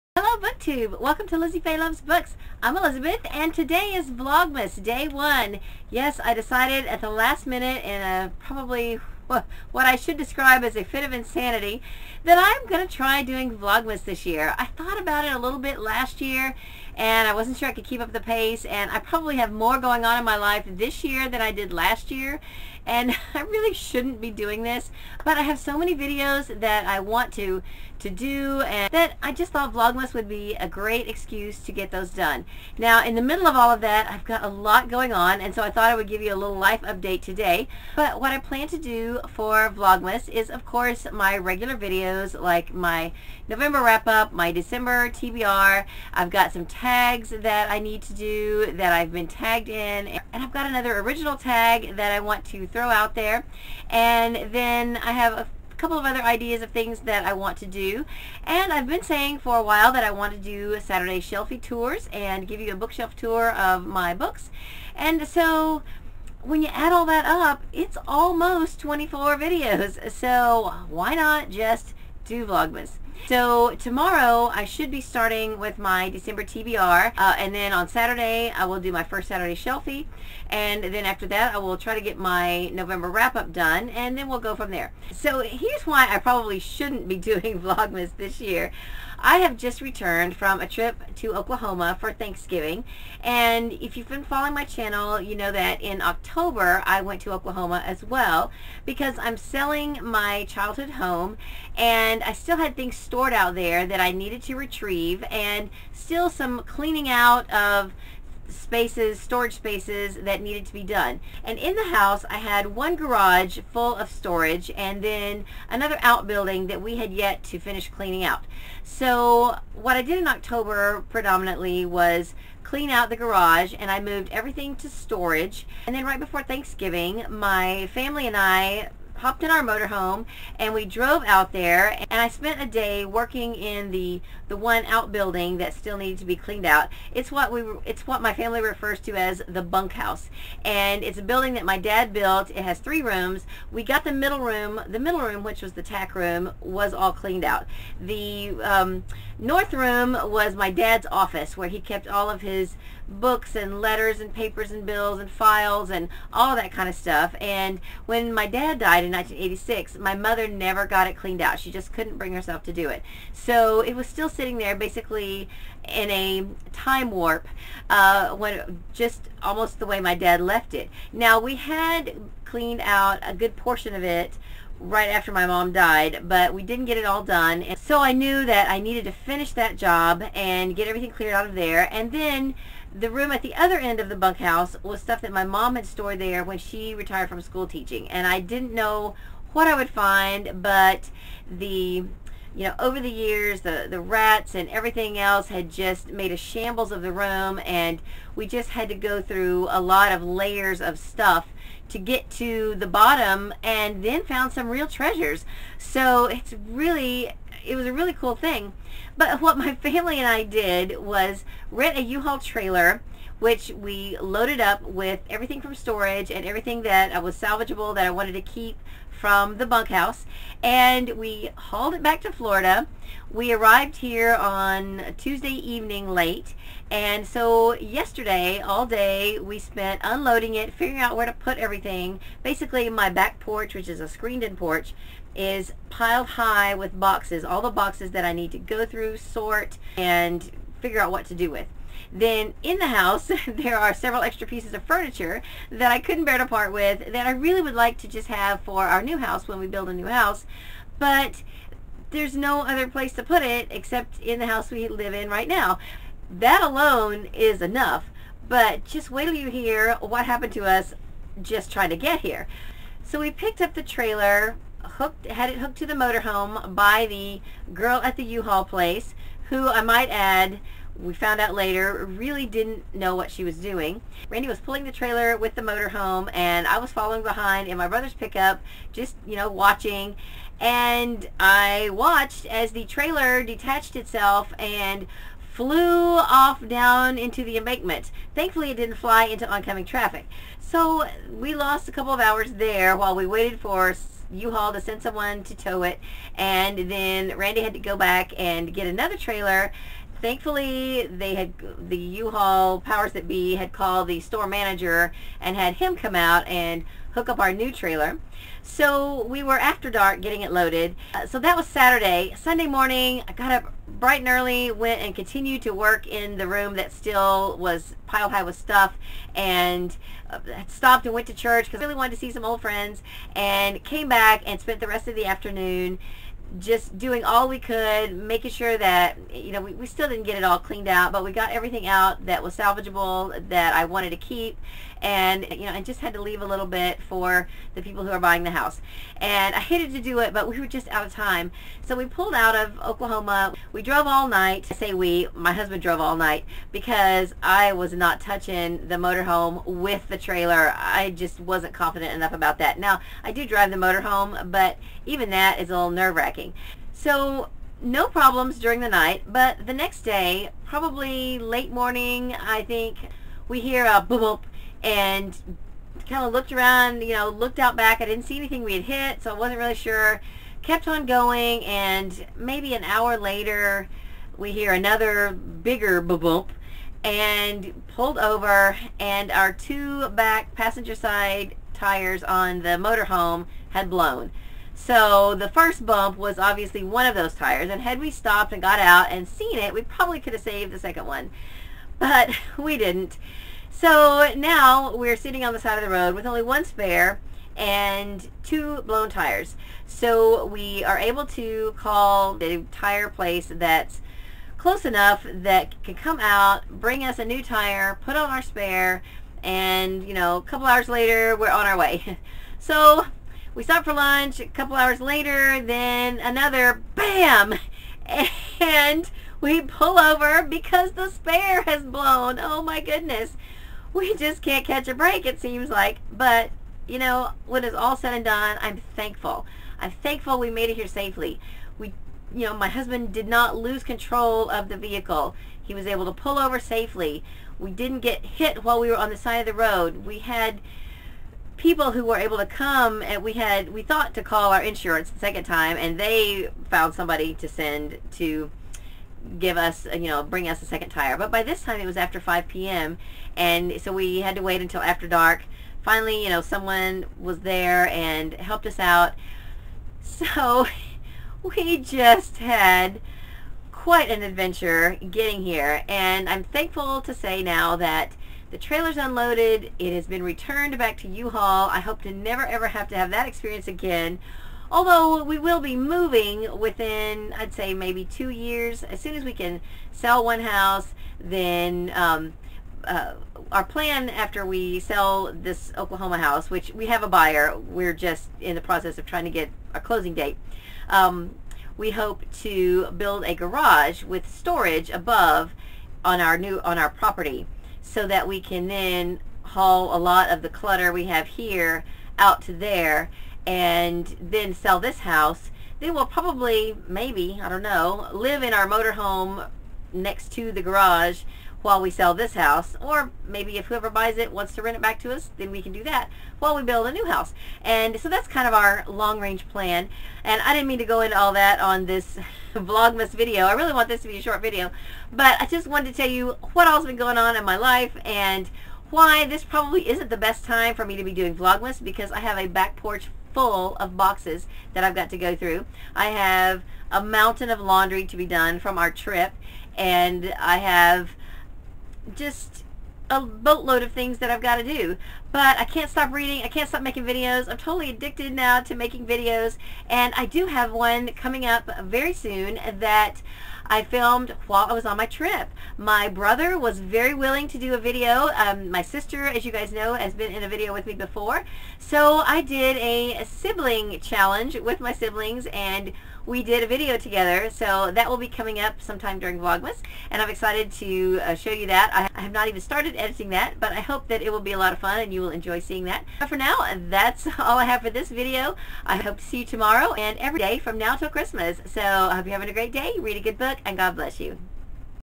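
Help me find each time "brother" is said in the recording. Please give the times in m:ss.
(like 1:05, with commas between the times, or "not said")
4:37, 9:16.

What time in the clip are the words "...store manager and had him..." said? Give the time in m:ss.
5:04.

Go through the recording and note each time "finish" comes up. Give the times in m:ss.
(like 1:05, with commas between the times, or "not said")
1:57, 2:59.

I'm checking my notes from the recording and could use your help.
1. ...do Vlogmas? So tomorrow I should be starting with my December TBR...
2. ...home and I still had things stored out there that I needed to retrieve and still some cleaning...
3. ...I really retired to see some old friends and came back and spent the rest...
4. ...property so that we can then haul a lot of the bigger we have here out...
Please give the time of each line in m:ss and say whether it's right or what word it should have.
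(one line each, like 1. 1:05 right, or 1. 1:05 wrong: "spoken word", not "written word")
1. 1:12 right
2. 1:40 right
3. 5:21 wrong: "wanted", not "retired"
4. 8:16 wrong: "clutter", not "bigger".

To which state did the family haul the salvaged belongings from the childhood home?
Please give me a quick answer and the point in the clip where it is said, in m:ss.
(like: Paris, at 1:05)
Florida, at 3:42.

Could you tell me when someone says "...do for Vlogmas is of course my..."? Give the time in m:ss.
0:38.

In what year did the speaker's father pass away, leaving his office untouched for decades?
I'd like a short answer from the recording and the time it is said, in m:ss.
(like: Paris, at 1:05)
1986, at 2:39.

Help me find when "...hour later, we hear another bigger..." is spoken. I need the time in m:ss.
6:12.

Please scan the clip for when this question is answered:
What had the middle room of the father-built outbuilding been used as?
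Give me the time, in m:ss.
2:25.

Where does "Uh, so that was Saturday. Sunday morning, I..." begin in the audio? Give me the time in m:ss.
5:11.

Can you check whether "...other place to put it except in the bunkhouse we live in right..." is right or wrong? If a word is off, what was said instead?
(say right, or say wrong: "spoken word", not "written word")
wrong: "house", not "bunkhouse".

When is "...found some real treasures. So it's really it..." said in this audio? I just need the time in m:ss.
3:24.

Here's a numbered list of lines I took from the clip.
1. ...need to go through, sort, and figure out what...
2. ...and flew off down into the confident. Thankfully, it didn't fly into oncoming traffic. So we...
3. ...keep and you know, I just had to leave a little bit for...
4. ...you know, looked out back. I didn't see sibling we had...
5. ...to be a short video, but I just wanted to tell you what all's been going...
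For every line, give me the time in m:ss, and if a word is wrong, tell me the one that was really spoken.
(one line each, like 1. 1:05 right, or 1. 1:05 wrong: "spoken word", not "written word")
1. 3:58 right
2. 4:44 wrong: "embankment", not "confident"
3. 5:34 right
4. 6:07 wrong: "anything", not "sibling"
5. 8:44 right.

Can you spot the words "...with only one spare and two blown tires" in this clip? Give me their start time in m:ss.
6:36.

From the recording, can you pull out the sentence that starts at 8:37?
And so that's kind of our long-range plan.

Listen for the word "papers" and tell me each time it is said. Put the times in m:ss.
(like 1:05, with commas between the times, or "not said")
2:34.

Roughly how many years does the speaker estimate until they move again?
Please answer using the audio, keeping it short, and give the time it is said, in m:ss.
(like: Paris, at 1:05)
2, at 7:58.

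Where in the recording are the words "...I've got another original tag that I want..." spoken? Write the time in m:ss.
0:50.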